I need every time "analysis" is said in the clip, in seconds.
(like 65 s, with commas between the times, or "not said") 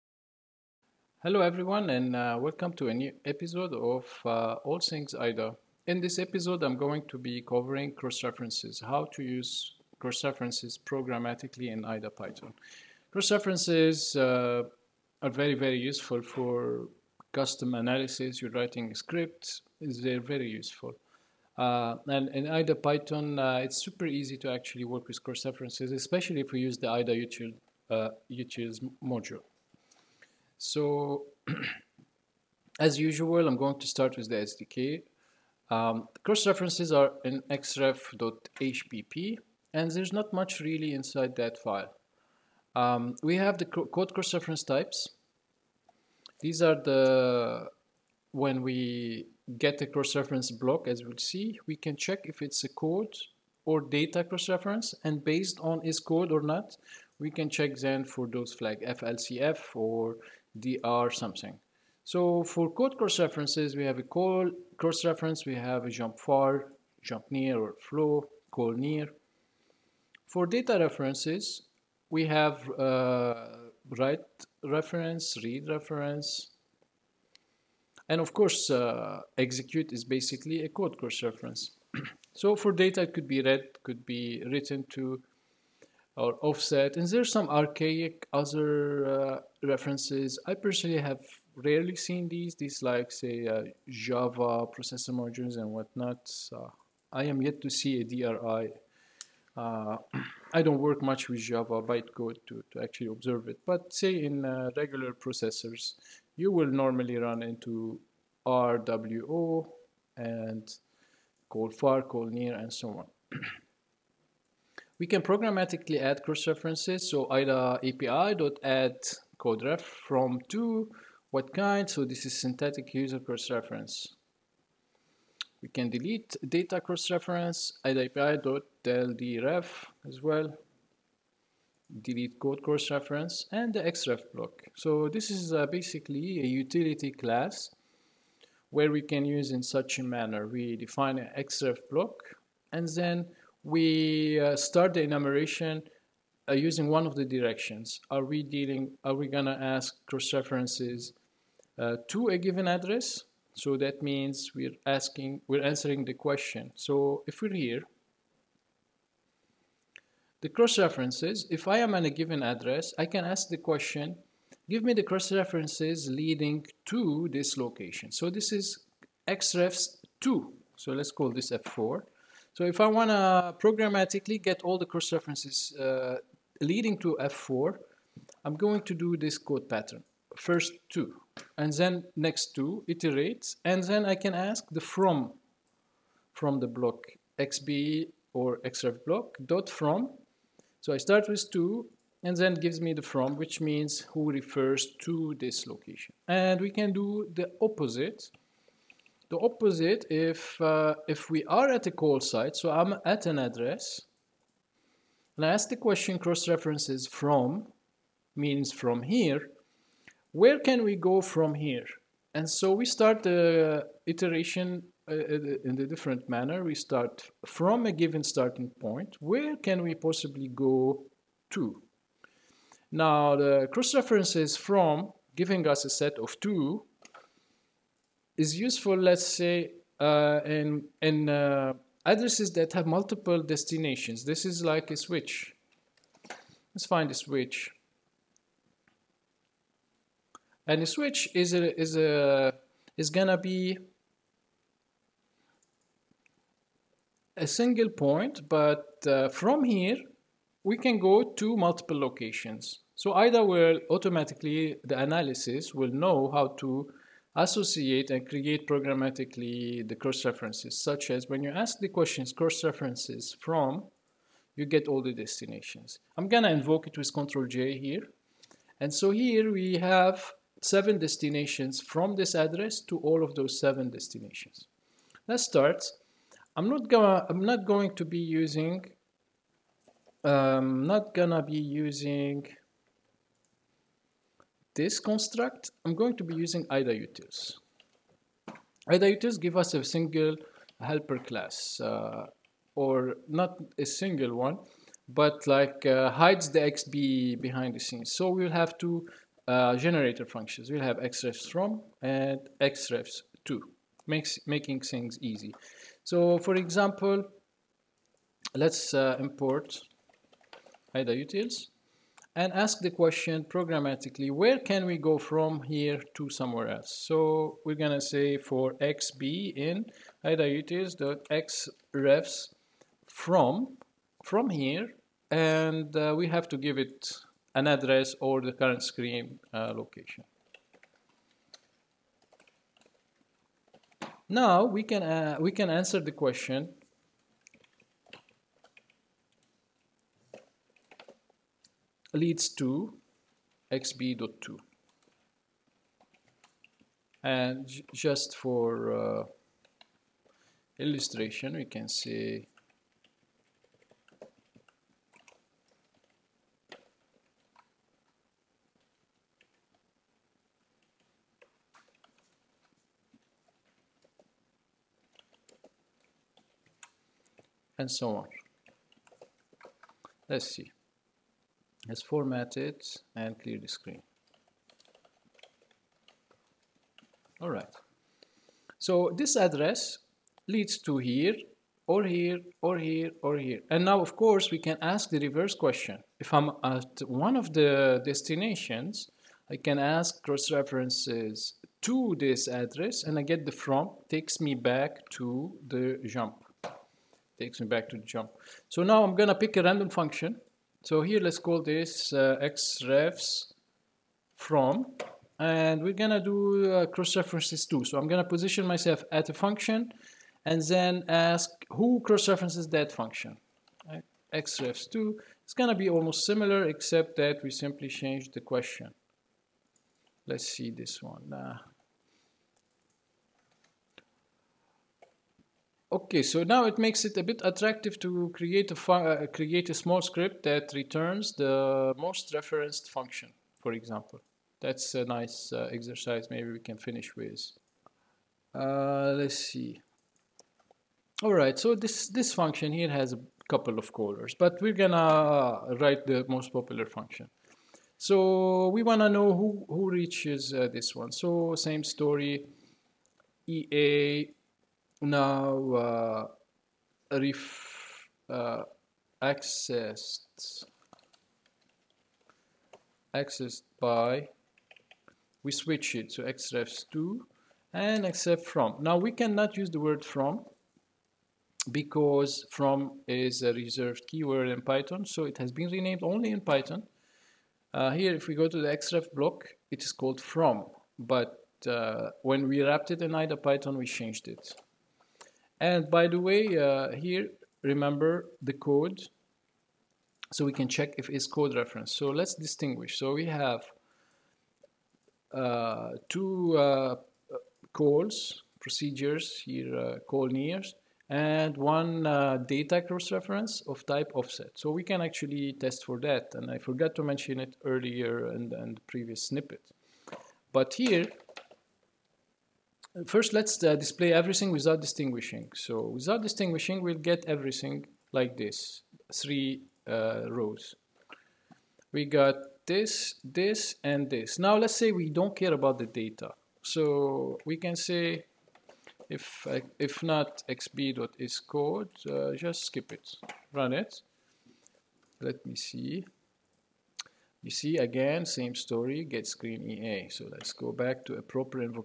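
17 s, 254 s.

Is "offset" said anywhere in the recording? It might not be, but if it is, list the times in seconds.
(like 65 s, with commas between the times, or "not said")
86 s, 504 s.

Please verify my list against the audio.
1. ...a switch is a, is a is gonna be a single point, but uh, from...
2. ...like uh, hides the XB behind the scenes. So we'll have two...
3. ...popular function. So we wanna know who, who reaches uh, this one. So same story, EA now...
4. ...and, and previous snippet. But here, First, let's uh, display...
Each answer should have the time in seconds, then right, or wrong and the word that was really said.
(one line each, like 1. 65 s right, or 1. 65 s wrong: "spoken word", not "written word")
1. 240 s right
2. 295 s right
3. 446 s right
4. 508 s right.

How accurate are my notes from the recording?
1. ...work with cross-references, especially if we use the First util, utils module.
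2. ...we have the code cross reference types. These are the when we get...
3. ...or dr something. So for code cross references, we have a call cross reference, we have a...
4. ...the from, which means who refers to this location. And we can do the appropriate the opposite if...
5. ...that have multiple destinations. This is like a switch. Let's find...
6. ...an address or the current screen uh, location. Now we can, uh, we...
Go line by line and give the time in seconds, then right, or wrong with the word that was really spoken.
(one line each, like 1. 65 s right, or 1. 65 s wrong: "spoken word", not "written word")
1. 24 s wrong: "IDA", not "First"
2. 43 s right
3. 59 s right
4. 192 s wrong: "opposite", not "appropriate"
5. 232 s right
6. 327 s right.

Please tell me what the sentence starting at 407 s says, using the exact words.
So I'm gonna position myself at a function and then ask who cross references that function.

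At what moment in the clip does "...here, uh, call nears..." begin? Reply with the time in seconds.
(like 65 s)
499 s.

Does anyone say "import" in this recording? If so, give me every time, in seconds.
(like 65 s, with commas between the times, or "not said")
309 s.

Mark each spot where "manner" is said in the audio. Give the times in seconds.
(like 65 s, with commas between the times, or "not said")
140 s, 216 s.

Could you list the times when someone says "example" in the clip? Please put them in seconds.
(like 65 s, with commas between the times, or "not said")
306 s, 433 s.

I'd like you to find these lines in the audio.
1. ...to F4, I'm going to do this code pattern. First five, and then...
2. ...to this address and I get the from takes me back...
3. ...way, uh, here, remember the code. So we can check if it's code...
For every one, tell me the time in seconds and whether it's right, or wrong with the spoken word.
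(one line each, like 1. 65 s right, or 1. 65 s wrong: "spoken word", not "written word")
1. 176 s wrong: "two", not "five"
2. 391 s right
3. 486 s right.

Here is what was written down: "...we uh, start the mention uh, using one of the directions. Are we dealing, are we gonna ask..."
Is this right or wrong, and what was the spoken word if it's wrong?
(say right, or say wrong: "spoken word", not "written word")
wrong: "enumeration", not "mention".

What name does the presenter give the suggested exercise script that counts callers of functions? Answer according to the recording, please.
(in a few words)
most referenced function.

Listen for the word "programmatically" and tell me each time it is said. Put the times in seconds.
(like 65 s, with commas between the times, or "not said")
10 s, 115 s, 173 s, 258 s, 313 s.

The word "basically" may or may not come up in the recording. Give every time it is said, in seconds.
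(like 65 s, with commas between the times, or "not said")
80 s, 135 s.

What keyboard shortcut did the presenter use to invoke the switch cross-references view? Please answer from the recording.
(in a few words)
Control J.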